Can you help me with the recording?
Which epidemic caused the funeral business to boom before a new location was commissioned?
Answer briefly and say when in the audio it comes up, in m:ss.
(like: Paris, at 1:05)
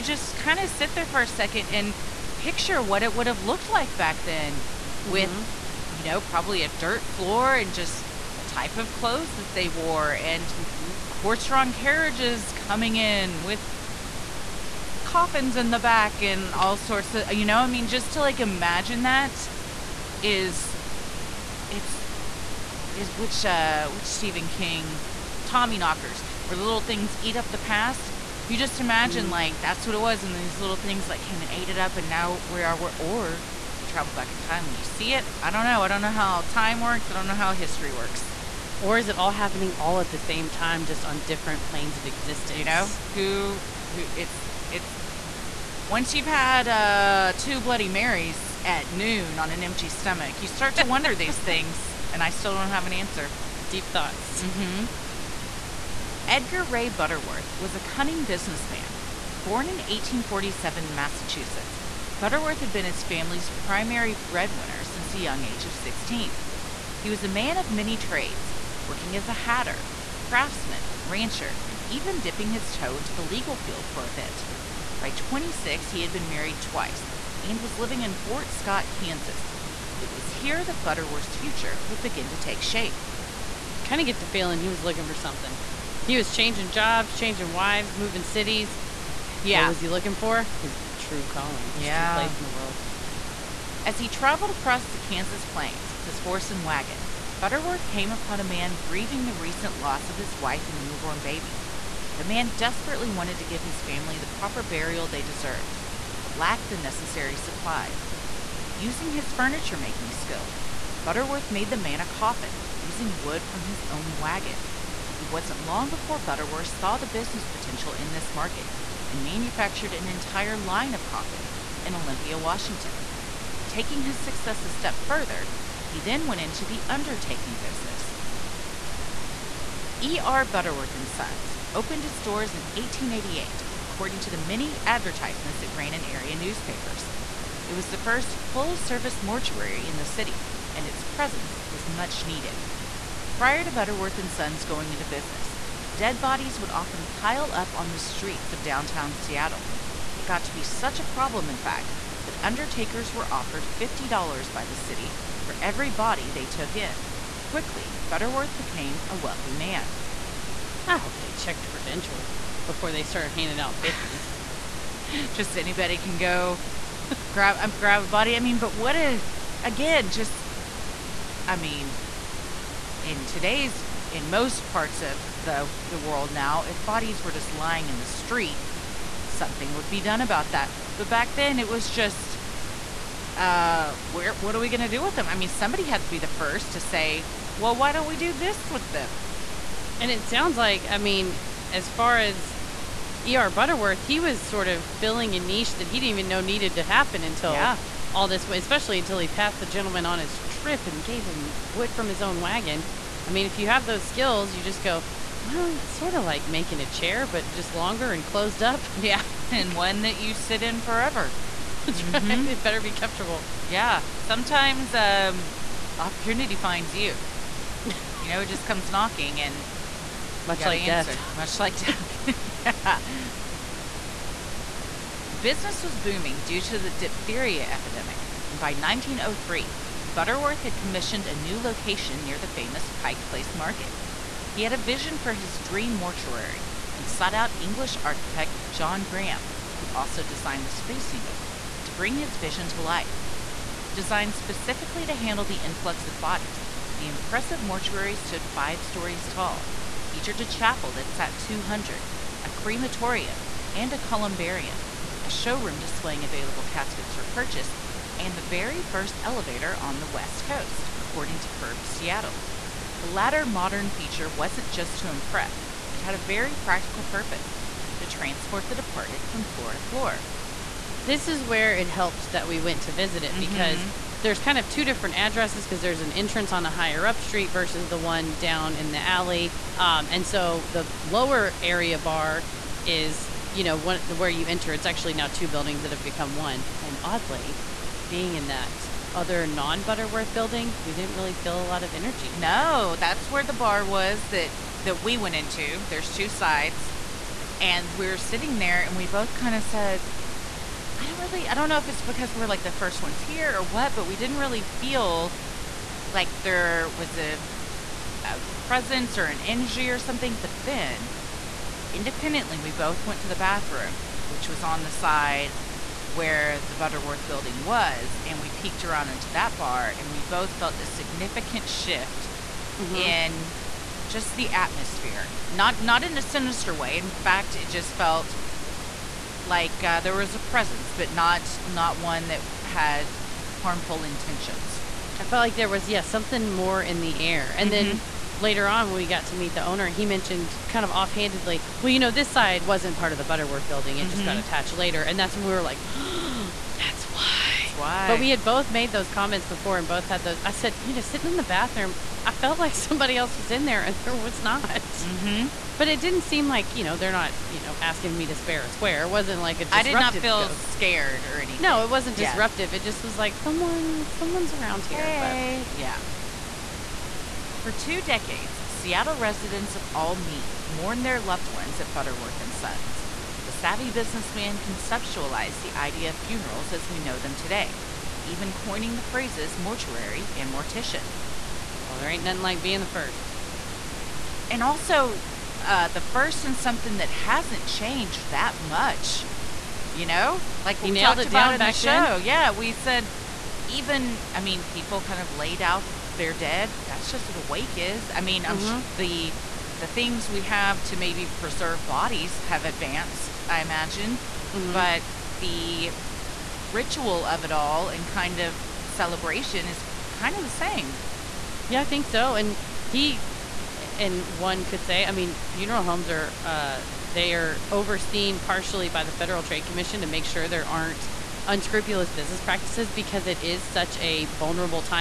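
Diphtheria, at 3:46.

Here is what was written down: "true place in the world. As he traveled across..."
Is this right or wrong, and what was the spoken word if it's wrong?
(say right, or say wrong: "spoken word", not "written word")
right.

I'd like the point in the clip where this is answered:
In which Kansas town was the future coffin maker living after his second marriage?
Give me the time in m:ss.
1:18.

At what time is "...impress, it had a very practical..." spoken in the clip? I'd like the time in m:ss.
4:25.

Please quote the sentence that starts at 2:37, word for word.
Quickly, Butterworth became a wealthy man.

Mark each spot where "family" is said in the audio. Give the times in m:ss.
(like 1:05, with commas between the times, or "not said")
1:03, 1:43.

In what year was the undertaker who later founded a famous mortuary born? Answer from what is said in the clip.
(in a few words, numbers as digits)
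1847.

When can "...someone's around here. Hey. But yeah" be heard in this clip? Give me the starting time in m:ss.
6:04.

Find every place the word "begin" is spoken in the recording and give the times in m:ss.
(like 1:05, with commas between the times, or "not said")
1:22.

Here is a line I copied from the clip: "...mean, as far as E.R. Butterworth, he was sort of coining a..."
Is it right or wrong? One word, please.
wrong.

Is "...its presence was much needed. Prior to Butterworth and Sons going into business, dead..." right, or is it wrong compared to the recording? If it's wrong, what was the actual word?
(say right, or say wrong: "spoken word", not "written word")
right.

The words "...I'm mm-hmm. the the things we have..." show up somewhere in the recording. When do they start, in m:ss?
6:38.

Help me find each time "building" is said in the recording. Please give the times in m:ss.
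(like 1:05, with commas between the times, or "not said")
4:45, 4:50, 5:17, 5:43.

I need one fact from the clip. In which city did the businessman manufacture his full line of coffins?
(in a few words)
Olympia, Washington.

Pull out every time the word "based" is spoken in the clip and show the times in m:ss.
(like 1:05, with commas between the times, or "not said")
not said.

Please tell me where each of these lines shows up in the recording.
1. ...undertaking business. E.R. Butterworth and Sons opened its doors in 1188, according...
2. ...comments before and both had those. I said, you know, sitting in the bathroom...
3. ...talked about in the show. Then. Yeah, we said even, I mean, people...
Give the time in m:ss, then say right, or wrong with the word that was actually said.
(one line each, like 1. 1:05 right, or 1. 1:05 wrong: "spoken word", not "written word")
1. 2:06 wrong: "1888", not "1188"
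2. 5:49 right
3. 6:30 right.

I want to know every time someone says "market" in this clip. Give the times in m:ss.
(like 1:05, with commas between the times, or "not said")
1:58, 3:53.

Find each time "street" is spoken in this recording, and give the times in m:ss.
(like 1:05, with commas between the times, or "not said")
2:27, 2:58, 4:37.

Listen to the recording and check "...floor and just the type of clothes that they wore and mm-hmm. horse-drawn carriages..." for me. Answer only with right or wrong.
right.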